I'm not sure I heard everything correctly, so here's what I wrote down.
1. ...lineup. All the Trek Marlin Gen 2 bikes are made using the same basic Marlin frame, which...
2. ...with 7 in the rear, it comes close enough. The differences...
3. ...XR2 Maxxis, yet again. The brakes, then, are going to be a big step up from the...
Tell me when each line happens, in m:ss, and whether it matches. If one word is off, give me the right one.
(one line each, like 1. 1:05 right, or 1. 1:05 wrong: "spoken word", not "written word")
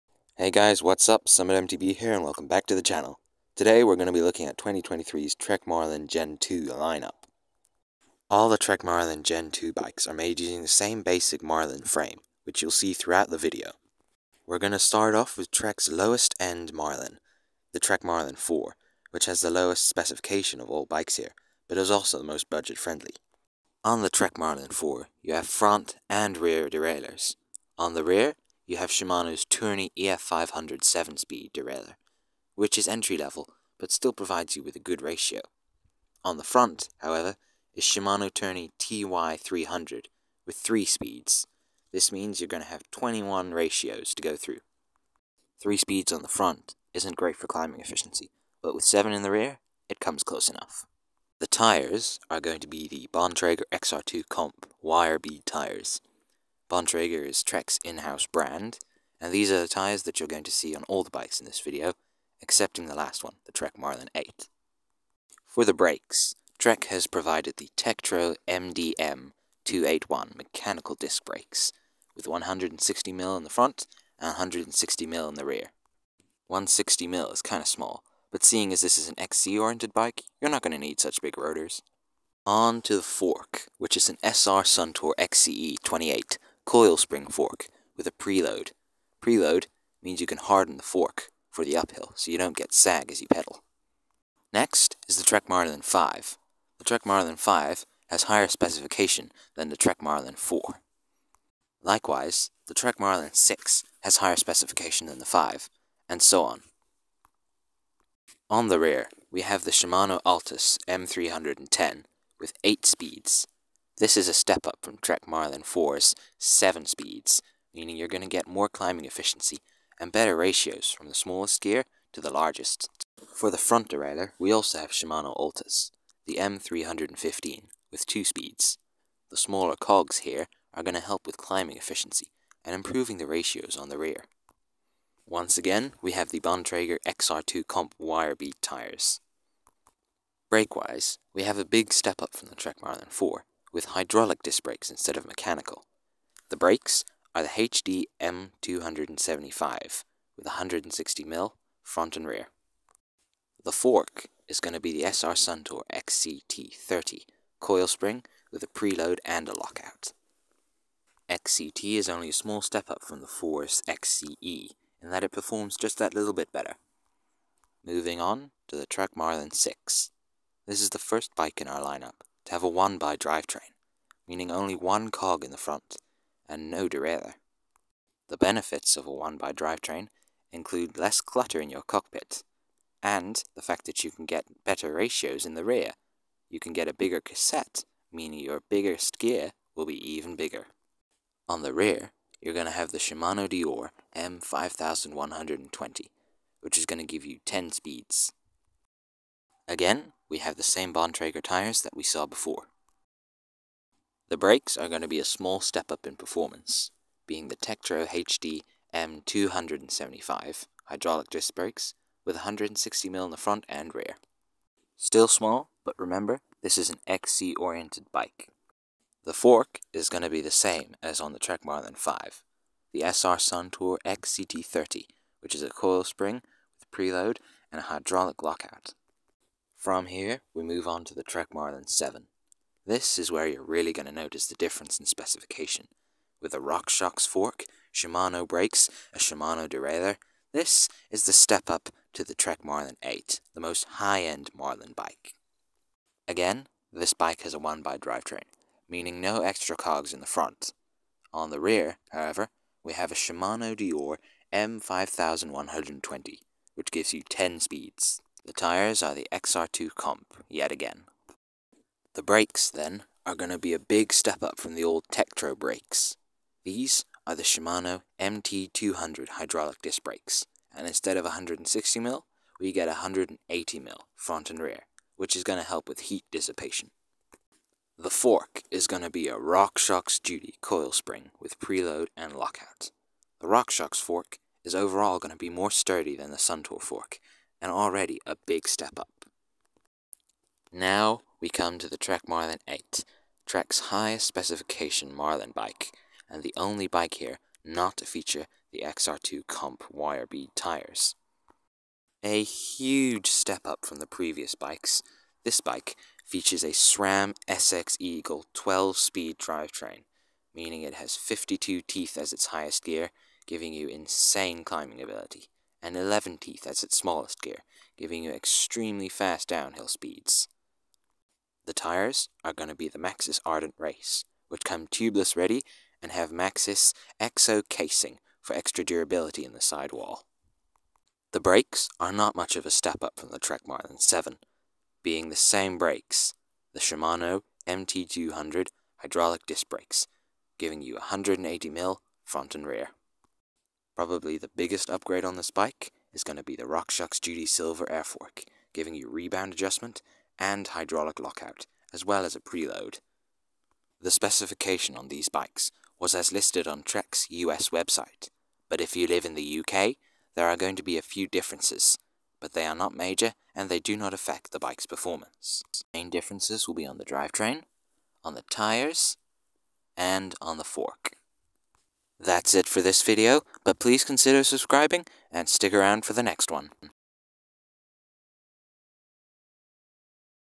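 1. 0:06 right
2. 0:48 wrong: "tires", not "differences"
3. 4:19 wrong: "Comp", not "Maxxis".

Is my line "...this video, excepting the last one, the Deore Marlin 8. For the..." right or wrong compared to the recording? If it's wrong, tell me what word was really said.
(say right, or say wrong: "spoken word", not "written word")
wrong: "Trek", not "Deore".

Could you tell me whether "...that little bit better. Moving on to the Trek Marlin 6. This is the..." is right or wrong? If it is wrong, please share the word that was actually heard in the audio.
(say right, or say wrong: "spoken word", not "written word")
right.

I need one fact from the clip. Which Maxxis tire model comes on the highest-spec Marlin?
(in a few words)
Ardent Race.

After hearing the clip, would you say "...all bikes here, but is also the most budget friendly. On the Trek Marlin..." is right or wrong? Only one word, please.
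right.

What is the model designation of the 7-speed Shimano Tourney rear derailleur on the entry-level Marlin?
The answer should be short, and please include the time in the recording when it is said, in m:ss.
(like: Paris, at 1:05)
EF500, at 0:29.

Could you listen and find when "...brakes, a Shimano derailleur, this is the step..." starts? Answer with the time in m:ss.
3:58.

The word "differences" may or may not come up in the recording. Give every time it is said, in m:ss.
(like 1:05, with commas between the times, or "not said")
3:54, 6:01, 6:06.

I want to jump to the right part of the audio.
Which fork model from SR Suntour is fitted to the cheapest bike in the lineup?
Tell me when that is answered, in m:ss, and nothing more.
1:25.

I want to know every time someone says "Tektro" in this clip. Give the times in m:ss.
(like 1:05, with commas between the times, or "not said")
1:07, 3:27, 4:25.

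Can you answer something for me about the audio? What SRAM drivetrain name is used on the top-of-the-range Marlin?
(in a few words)
SX Eagle.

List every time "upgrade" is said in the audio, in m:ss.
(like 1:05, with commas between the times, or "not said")
5:44.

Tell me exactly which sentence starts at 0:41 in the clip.
This means you're going to have 21 ratios to go through.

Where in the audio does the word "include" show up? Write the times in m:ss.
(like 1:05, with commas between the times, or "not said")
3:00.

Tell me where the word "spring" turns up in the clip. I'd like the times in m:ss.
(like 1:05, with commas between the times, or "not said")
1:26, 2:37, 3:46, 4:40.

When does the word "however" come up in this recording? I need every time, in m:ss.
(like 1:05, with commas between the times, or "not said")
0:36, 4:12.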